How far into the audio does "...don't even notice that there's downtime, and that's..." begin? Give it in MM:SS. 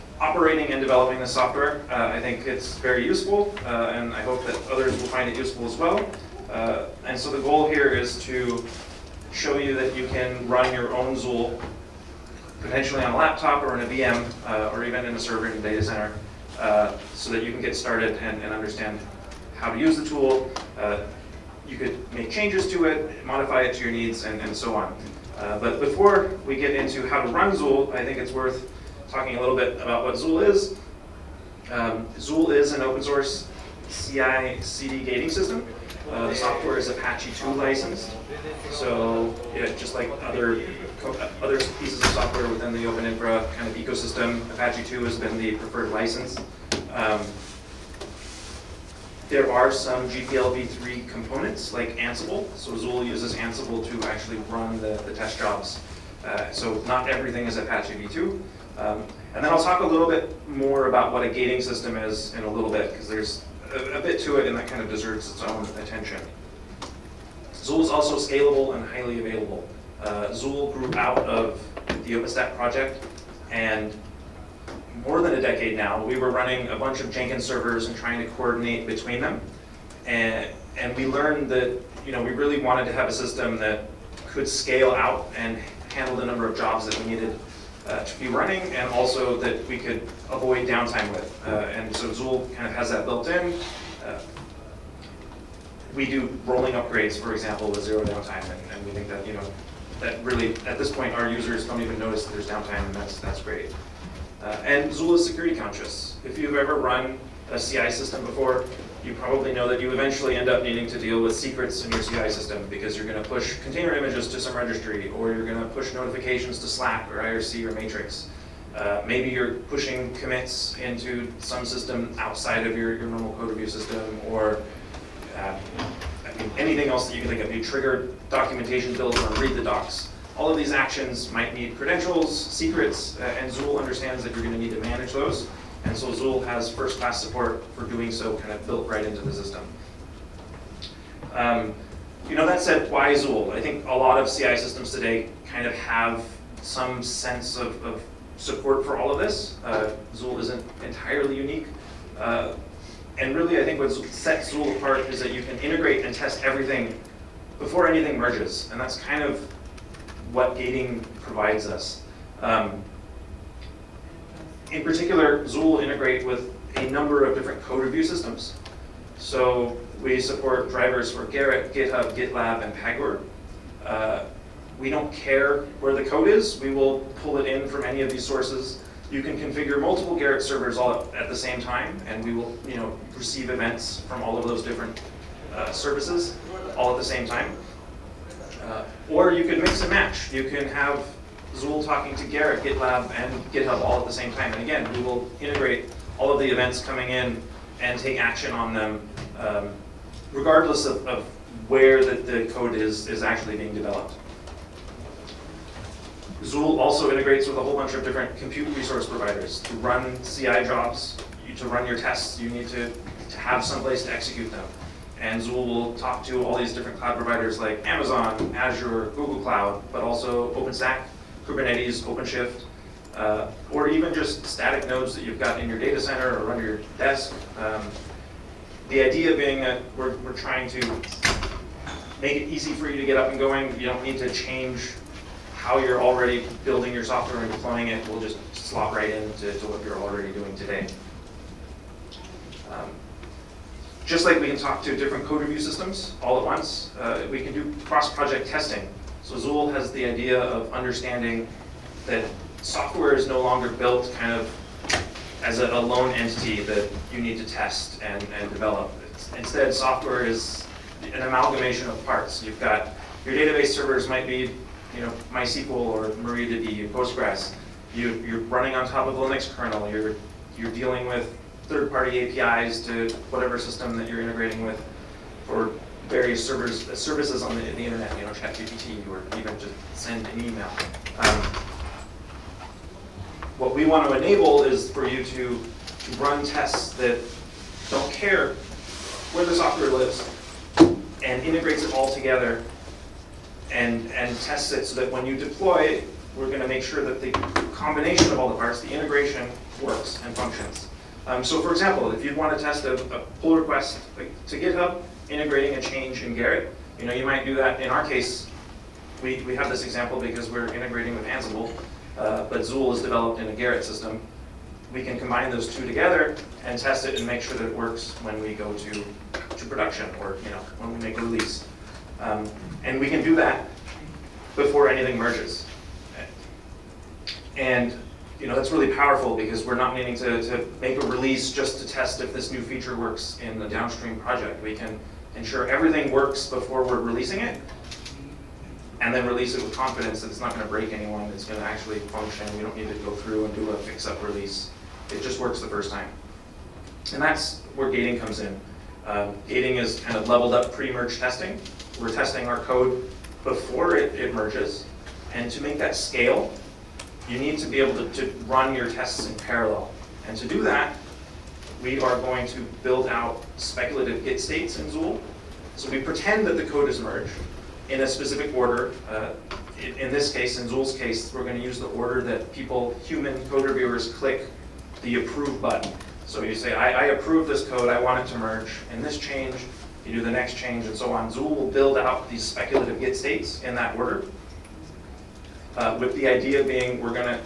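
01:41.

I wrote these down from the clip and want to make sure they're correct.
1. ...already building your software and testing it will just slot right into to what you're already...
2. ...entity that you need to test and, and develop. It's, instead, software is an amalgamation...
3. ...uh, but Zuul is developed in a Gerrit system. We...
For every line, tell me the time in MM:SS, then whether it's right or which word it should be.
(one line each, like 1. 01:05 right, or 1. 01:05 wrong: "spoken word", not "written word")
1. 03:56 wrong: "deploying", not "testing"
2. 04:16 right
3. 05:12 right.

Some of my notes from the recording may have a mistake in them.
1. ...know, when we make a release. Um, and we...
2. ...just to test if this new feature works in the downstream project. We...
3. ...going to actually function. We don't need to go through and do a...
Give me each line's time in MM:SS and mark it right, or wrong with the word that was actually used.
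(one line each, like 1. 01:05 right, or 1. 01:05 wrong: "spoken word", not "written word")
1. 05:20 right
2. 05:31 right
3. 05:41 right.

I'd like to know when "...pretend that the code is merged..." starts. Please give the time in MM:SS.
06:05.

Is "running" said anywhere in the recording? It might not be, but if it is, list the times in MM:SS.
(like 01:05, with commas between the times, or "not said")
01:16, 01:28, 04:28.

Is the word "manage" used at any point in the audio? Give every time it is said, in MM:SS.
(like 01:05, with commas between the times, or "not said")
02:14.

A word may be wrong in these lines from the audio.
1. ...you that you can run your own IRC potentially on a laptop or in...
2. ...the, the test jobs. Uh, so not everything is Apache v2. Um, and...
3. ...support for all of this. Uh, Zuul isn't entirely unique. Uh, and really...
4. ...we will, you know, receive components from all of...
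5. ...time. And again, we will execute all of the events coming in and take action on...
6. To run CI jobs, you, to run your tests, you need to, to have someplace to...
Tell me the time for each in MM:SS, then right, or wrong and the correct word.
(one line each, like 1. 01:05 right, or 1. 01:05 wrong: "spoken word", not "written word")
1. 00:09 wrong: "Zuul", not "IRC"
2. 00:54 right
3. 02:28 right
4. 03:02 wrong: "events", not "components"
5. 03:14 wrong: "integrate", not "execute"
6. 03:29 right.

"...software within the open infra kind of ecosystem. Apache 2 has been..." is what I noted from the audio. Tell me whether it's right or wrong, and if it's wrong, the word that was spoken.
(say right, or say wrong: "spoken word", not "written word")
right.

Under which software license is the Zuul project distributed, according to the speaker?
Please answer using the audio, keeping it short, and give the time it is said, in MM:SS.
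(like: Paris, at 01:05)
Apache 2, at 00:36.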